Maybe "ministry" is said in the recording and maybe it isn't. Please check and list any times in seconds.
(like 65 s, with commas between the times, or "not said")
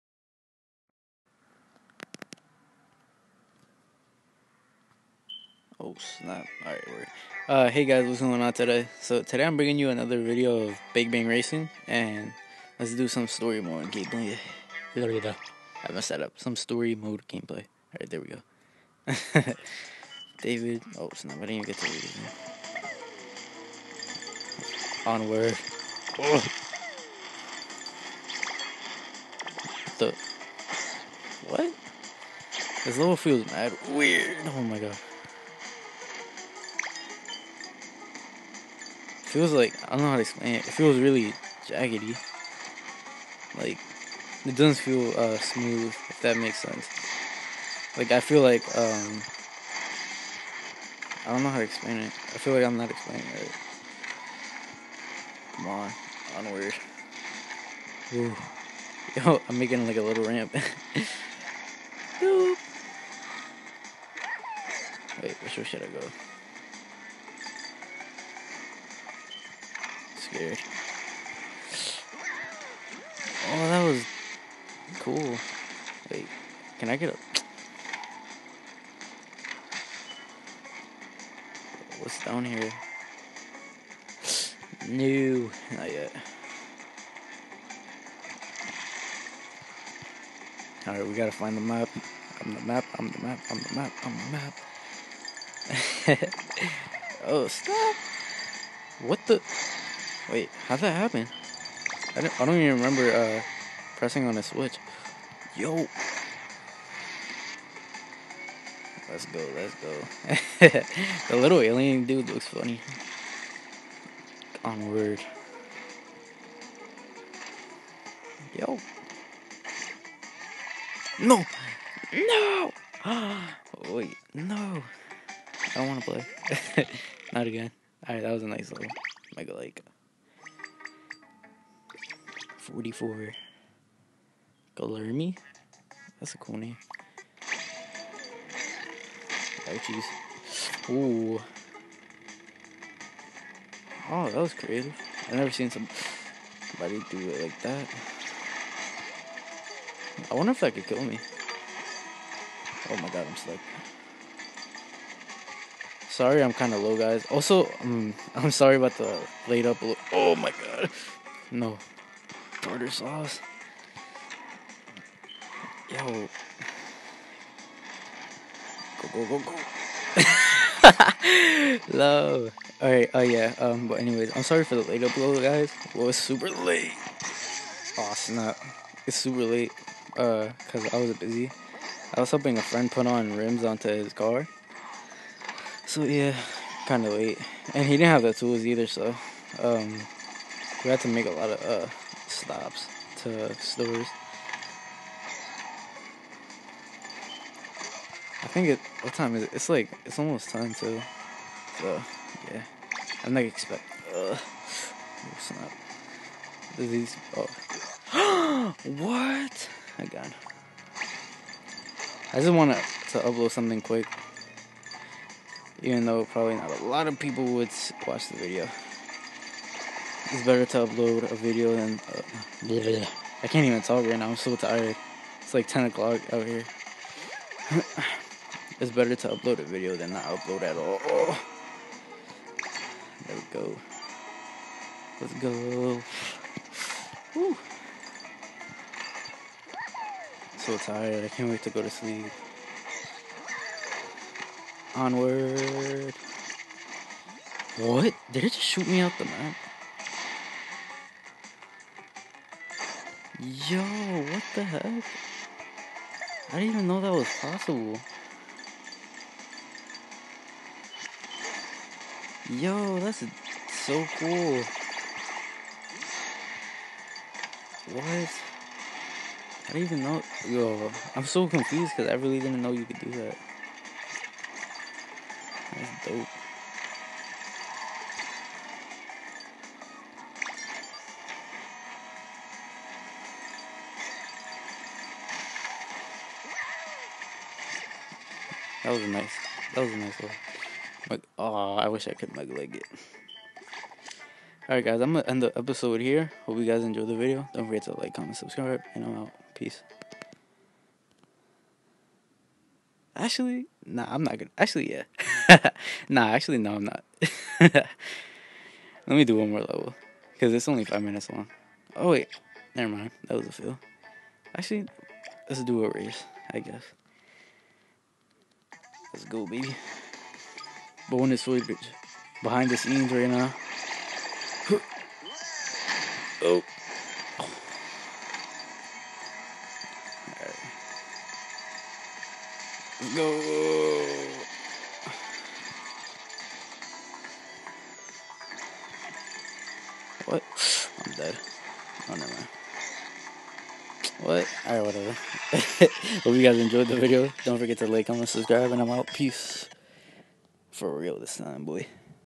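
not said.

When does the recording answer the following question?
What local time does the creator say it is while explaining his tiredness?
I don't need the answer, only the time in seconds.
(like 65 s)
225 s.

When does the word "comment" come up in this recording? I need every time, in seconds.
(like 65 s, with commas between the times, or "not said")
298 s, 348 s.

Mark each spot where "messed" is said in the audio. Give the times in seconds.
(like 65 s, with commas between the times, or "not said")
15 s.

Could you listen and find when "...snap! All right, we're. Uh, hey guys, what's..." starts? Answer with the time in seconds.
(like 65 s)
5 s.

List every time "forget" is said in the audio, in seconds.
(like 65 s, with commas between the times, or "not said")
297 s, 347 s.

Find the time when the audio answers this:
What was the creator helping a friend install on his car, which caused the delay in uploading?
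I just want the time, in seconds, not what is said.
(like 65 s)
183 s.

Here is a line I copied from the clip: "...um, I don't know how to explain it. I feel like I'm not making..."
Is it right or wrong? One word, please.
wrong.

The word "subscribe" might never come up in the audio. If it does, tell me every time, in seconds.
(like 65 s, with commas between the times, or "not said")
298 s, 348 s.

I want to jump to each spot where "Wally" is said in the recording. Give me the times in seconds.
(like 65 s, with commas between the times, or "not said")
not said.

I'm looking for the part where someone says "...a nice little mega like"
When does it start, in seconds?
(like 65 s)
128 s.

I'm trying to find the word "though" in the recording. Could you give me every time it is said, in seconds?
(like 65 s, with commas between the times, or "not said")
216 s.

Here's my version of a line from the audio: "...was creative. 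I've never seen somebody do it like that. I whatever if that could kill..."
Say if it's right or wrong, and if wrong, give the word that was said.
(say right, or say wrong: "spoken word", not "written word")
wrong: "wonder", not "whatever".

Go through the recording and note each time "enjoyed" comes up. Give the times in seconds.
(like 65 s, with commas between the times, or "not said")
296 s, 346 s.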